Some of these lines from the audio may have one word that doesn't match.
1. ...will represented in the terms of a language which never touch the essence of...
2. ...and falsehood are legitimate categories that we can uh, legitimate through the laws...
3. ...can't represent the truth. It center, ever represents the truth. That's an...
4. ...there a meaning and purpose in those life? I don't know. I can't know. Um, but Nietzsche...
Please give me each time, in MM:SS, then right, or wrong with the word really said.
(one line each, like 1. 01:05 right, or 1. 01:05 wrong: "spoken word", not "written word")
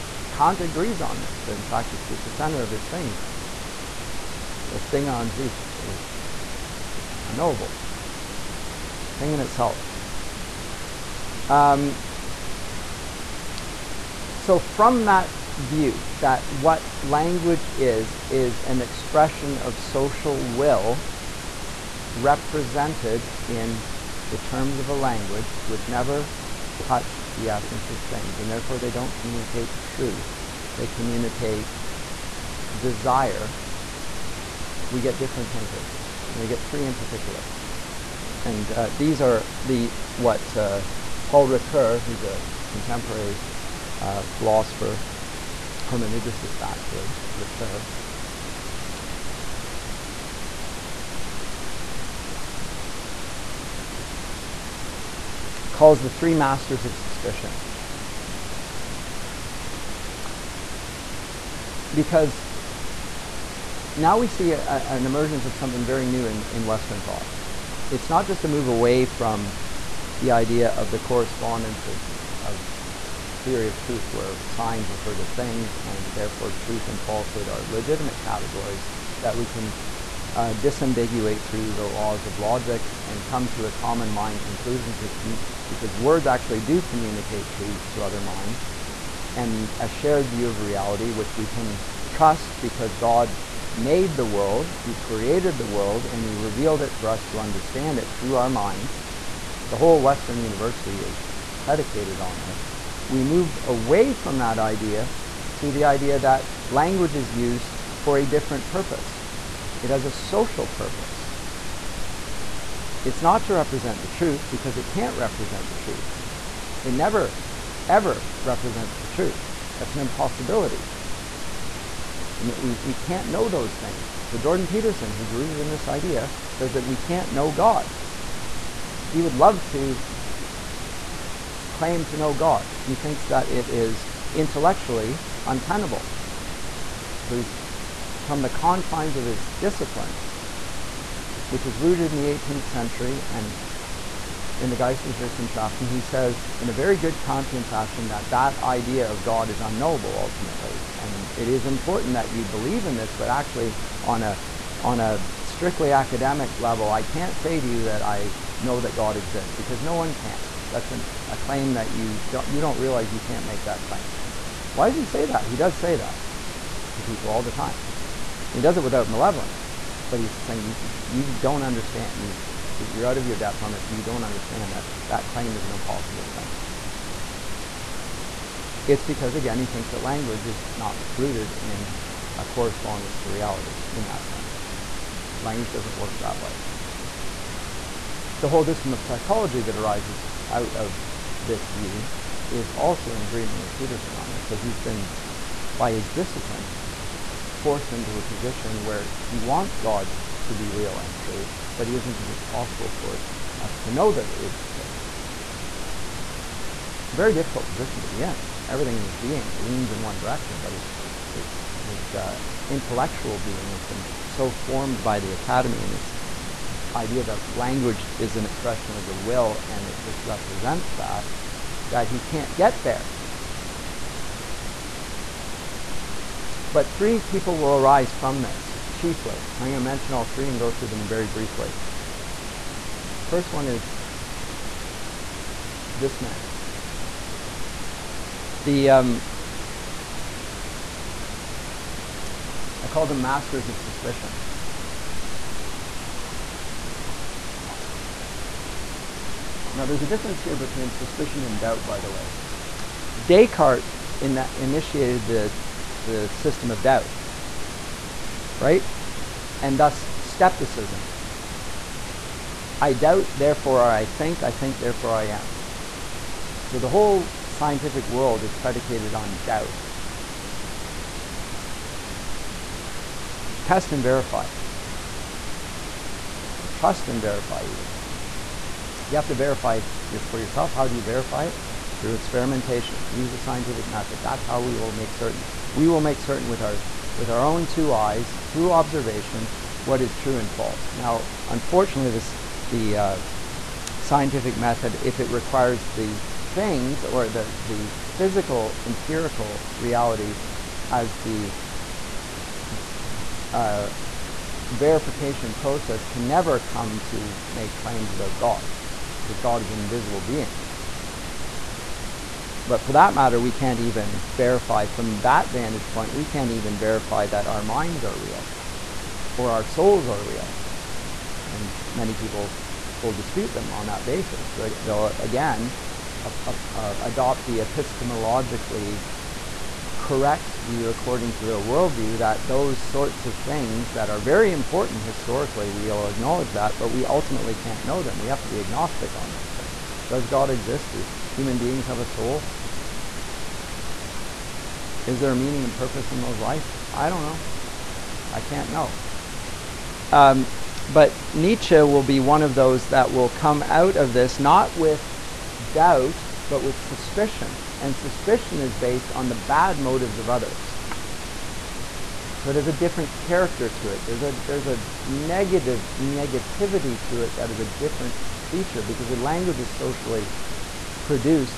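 1. 00:20 right
2. 01:16 wrong: "disambiguate", not "legitimate"
3. 01:54 wrong: "never", not "center"
4. 05:45 right.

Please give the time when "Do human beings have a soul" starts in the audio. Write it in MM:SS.
05:40.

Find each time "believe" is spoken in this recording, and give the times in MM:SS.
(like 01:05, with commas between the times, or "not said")
02:32.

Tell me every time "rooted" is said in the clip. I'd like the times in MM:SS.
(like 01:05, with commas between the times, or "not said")
02:05, 02:21, 03:01.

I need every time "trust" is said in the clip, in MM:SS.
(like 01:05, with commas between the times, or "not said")
01:32, 04:36.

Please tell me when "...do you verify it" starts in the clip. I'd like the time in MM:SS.
04:40.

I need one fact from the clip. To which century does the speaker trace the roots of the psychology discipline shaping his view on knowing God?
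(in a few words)
18th century.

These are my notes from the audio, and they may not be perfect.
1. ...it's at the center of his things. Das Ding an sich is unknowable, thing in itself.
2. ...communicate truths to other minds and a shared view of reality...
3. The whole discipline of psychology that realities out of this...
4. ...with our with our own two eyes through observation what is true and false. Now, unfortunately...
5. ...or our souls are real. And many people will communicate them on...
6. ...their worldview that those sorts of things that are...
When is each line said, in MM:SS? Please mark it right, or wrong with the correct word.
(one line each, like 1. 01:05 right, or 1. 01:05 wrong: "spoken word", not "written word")
1. 00:01 right
2. 01:26 right
3. 03:08 wrong: "arises", not "realities"
4. 04:46 right
5. 05:19 wrong: "dispute", not "communicate"
6. 05:31 right.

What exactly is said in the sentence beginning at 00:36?
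And we get three in particular.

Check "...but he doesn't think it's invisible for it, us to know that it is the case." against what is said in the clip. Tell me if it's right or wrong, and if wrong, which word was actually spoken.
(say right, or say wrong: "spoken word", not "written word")
wrong: "possible", not "invisible".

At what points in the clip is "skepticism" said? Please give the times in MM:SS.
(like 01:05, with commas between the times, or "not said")
04:20.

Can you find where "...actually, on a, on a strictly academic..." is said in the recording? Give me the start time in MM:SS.
02:33.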